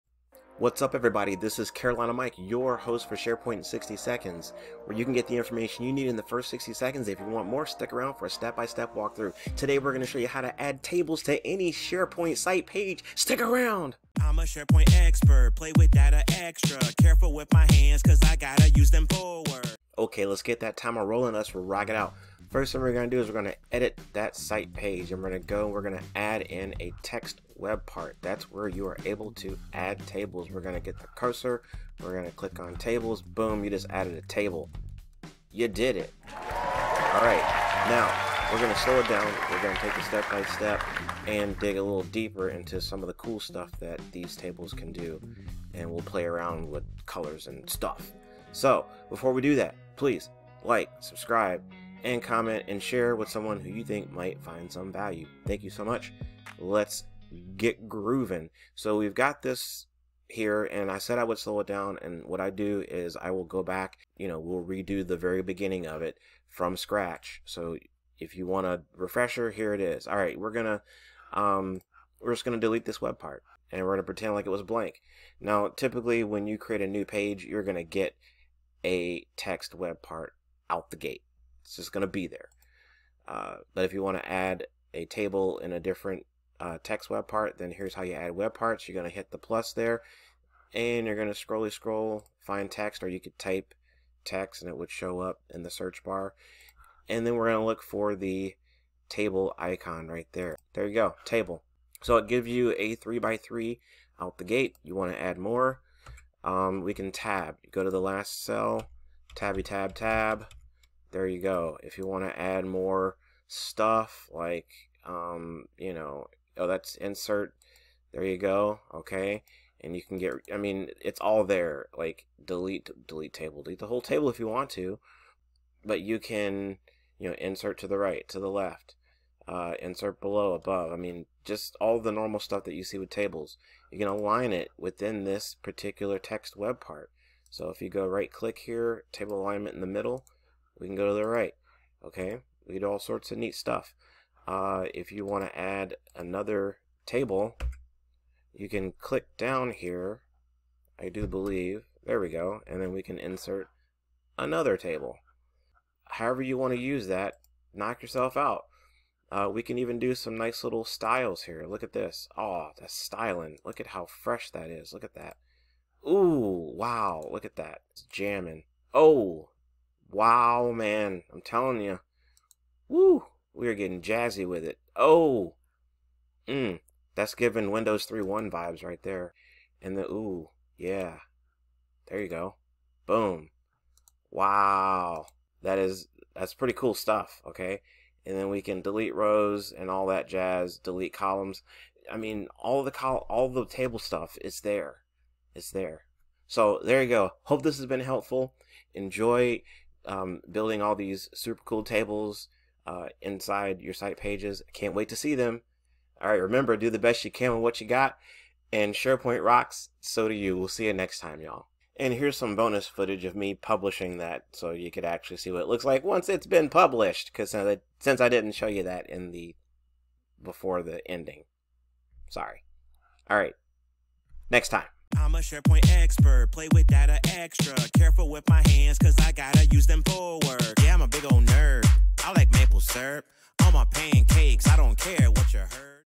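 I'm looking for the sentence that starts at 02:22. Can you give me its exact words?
Okay, we do all sorts of neat stuff.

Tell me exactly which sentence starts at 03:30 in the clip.
We'll see you next time, y'all.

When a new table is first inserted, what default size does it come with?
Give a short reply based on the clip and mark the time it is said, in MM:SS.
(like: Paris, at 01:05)
3x3, at 01:42.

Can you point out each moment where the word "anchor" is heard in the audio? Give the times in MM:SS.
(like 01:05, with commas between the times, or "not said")
not said.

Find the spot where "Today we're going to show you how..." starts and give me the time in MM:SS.
00:09.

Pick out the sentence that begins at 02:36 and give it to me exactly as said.
However you want to use that, knock yourself out.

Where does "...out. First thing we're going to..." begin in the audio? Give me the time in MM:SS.
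00:21.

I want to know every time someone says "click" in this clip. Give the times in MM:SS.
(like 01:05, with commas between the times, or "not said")
00:32, 02:18, 02:28.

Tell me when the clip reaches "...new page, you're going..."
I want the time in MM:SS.
01:16.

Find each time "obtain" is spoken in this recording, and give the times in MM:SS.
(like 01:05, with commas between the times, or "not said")
not said.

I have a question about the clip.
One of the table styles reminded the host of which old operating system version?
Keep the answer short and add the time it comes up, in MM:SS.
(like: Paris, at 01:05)
Windows 3.1, at 02:57.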